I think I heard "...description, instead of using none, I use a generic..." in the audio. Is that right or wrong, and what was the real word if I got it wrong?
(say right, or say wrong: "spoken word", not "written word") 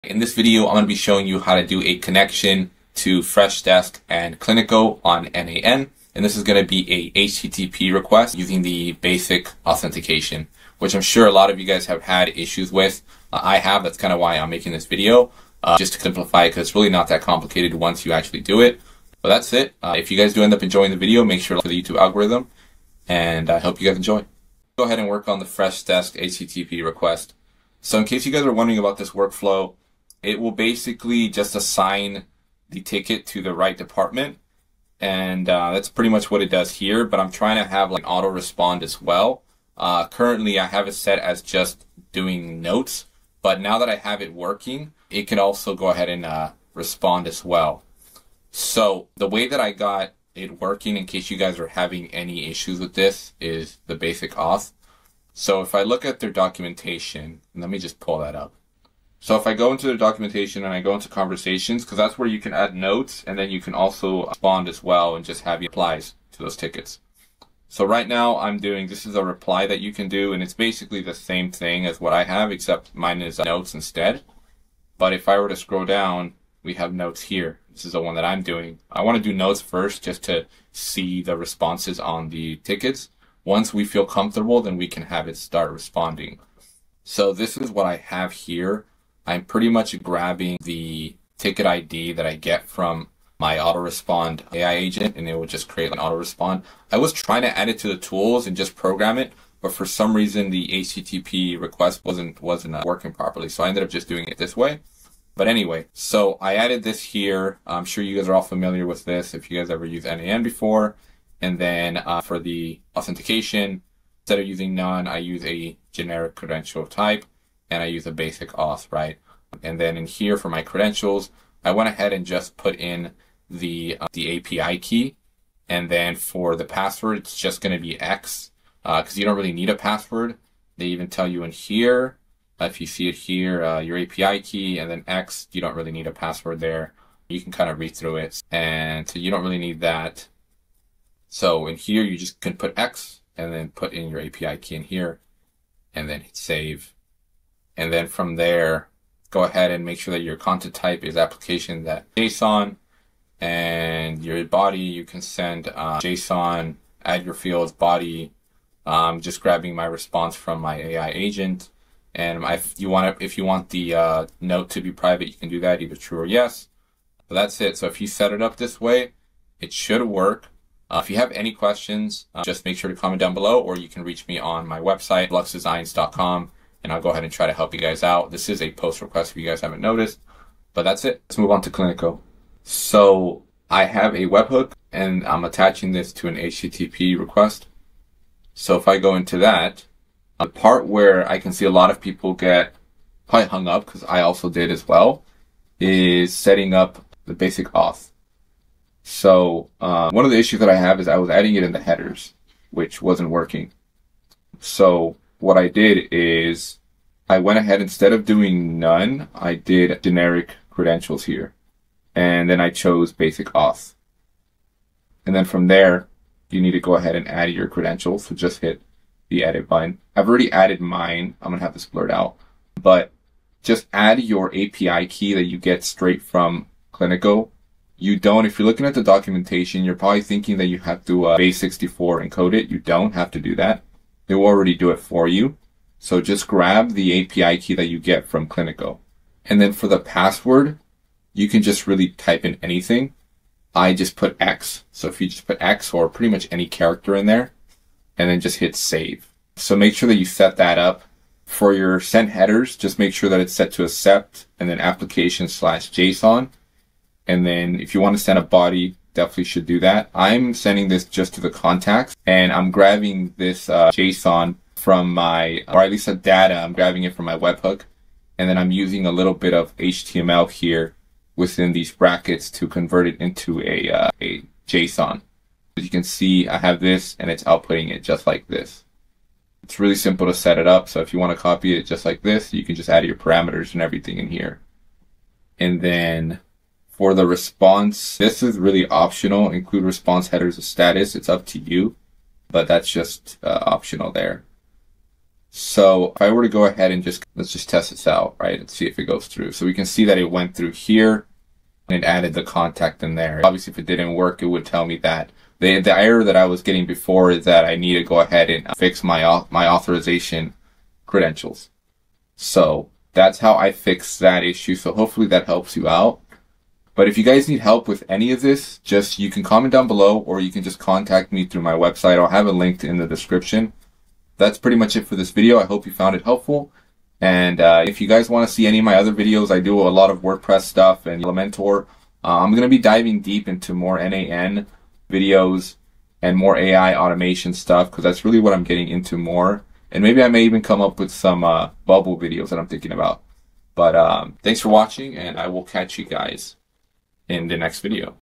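wrong: "authentication", not "description".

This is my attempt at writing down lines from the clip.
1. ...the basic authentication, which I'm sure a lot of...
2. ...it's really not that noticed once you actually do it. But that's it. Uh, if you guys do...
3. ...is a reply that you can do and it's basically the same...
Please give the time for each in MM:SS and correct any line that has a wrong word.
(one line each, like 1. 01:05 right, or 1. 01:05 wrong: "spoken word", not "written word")
1. 00:08 right
2. 00:16 wrong: "complicated", not "noticed"
3. 01:09 right.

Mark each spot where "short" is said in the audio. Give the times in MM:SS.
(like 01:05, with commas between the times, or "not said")
not said.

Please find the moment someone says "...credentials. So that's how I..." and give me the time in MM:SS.
05:11.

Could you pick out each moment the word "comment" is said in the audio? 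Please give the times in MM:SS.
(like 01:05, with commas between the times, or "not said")
02:52, 05:19.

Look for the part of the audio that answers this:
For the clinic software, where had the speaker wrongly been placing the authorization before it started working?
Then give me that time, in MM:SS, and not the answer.
03:21.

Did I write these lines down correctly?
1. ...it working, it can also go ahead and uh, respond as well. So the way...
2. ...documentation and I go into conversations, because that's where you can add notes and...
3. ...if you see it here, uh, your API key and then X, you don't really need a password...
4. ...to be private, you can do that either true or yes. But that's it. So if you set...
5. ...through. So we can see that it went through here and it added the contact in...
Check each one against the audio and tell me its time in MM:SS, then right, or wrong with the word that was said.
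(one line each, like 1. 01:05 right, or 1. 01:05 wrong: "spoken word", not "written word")
1. 00:44 right
2. 00:59 right
3. 02:12 right
4. 02:44 right
5. 04:59 right.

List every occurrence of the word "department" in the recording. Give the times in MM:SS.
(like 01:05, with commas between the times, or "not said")
00:33.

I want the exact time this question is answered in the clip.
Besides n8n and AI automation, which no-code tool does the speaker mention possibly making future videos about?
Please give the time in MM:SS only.
05:41.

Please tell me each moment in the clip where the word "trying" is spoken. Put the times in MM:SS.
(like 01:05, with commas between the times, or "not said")
00:37, 01:37.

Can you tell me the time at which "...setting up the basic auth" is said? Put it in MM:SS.
03:16.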